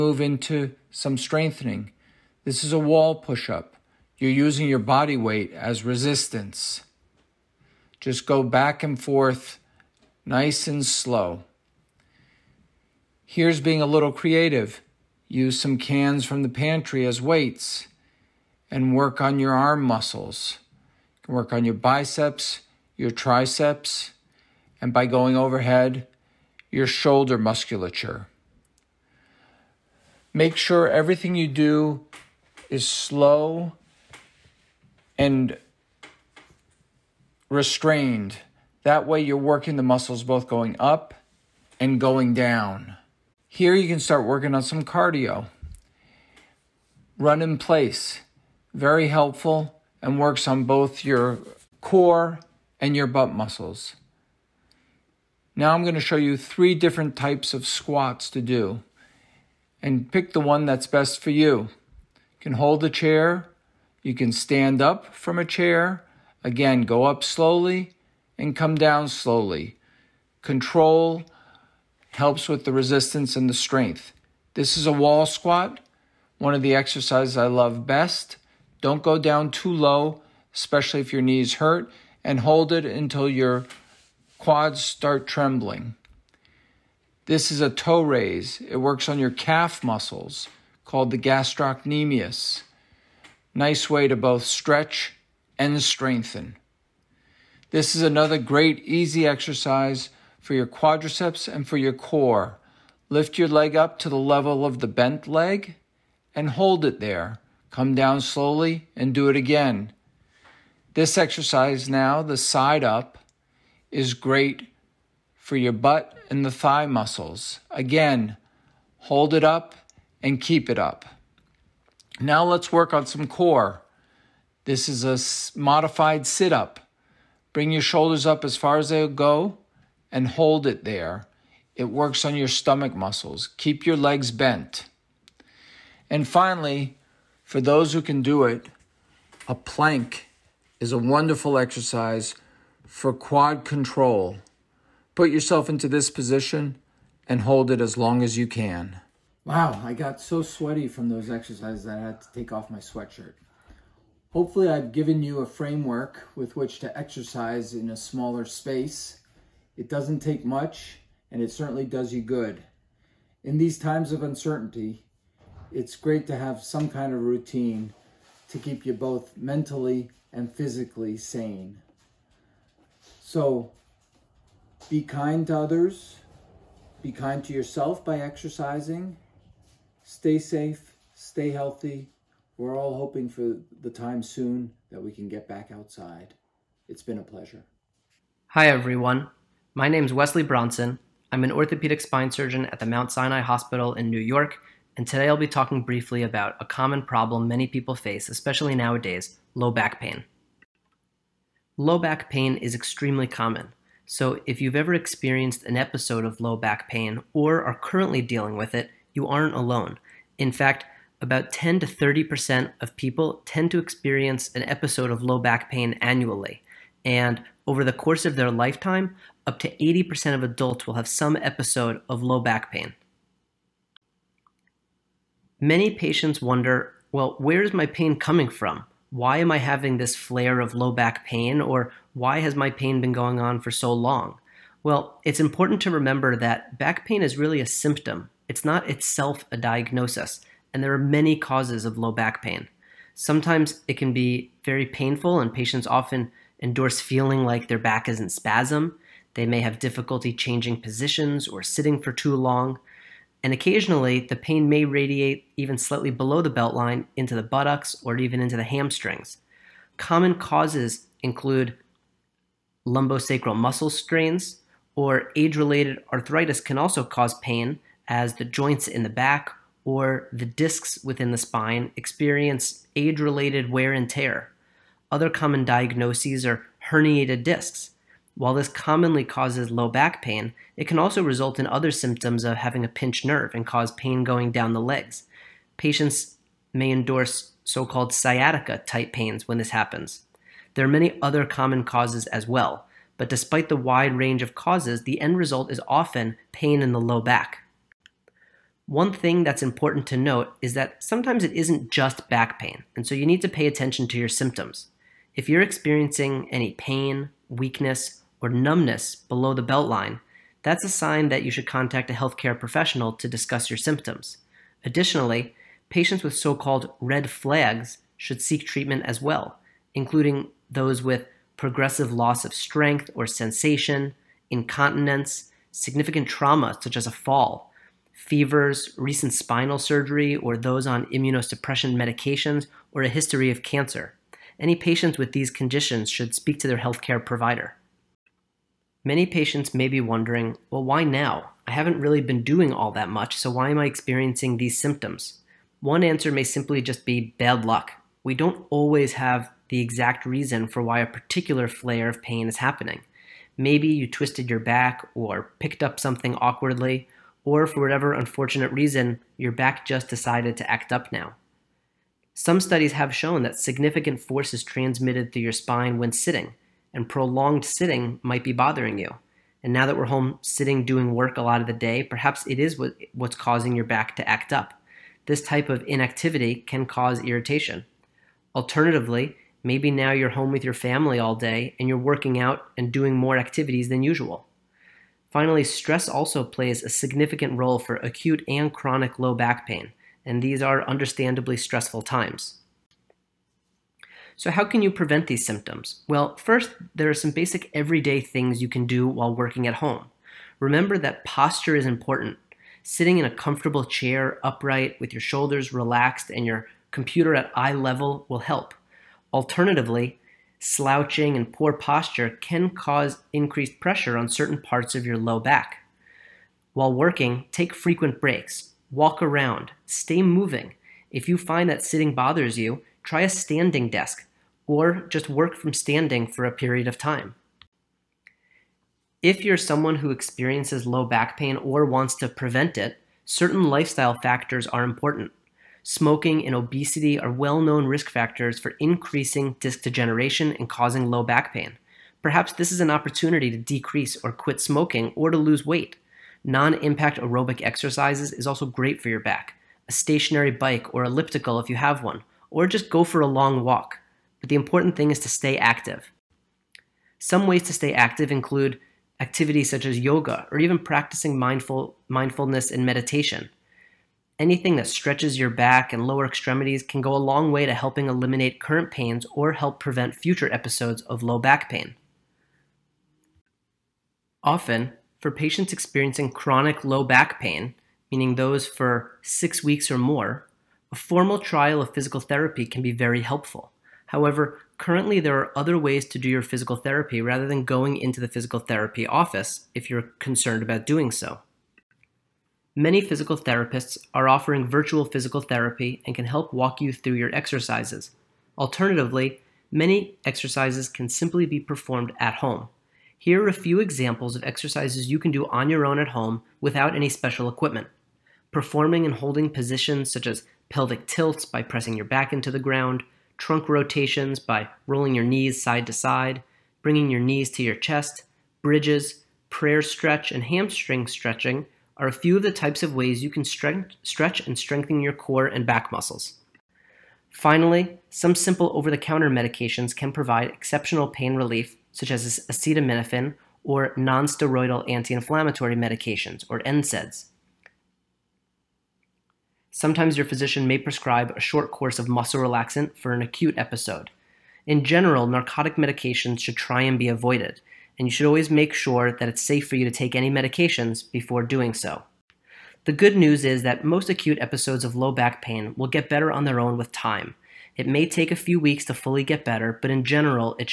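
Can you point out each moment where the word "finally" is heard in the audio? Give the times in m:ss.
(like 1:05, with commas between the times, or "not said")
2:16, 6:25, 8:47.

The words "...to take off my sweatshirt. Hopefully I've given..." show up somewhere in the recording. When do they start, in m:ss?
2:32.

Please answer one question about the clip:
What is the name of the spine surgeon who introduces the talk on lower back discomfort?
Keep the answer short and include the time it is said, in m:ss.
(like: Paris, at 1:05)
Wesley Bronson, at 3:10.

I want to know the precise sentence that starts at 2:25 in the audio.
Put yourself into this position and hold it as long as you can.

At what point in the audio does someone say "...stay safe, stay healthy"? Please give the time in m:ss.
3:00.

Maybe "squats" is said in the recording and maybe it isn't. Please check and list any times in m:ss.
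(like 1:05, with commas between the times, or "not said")
0:57, 1:15.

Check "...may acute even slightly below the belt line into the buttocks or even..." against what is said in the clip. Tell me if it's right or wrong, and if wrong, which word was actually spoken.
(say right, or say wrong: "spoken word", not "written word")
wrong: "radiate", not "acute".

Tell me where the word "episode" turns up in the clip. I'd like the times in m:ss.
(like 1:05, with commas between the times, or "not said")
3:25, 3:34, 3:41, 7:50, 9:03, 9:14.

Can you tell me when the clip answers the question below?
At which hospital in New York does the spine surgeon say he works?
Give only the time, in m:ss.
3:12.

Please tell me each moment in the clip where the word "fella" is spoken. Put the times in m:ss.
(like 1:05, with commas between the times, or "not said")
not said.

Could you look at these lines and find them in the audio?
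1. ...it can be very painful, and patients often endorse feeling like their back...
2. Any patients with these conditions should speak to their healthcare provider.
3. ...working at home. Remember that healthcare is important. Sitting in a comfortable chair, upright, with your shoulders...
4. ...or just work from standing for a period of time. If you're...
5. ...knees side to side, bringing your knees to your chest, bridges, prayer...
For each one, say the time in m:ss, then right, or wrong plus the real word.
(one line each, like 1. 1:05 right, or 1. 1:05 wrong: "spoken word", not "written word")
1. 4:03 right
2. 5:34 right
3. 6:39 wrong: "posture", not "healthcare"
4. 7:04 right
5. 8:35 right.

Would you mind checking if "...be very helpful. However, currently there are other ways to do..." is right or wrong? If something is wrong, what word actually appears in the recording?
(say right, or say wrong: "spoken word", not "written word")
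right.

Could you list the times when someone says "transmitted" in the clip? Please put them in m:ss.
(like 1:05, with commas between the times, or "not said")
6:04.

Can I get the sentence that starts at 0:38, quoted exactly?
That way, you're working the muscles both going up and going down.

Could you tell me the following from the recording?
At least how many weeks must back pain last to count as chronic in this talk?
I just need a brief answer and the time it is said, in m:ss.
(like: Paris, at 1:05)
6, at 7:59.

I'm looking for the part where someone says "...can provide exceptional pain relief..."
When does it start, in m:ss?
8:49.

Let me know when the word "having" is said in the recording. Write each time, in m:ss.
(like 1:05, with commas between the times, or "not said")
3:49, 4:42.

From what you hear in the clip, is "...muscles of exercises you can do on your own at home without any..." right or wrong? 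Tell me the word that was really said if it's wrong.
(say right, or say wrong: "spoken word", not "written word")
wrong: "examples", not "muscles".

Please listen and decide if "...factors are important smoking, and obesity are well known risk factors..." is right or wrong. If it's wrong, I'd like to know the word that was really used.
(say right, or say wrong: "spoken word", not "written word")
right.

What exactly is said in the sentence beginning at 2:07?
Bring your shoulders up as far as they'll go and hold it there.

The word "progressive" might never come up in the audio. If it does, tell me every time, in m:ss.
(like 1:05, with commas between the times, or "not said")
5:21.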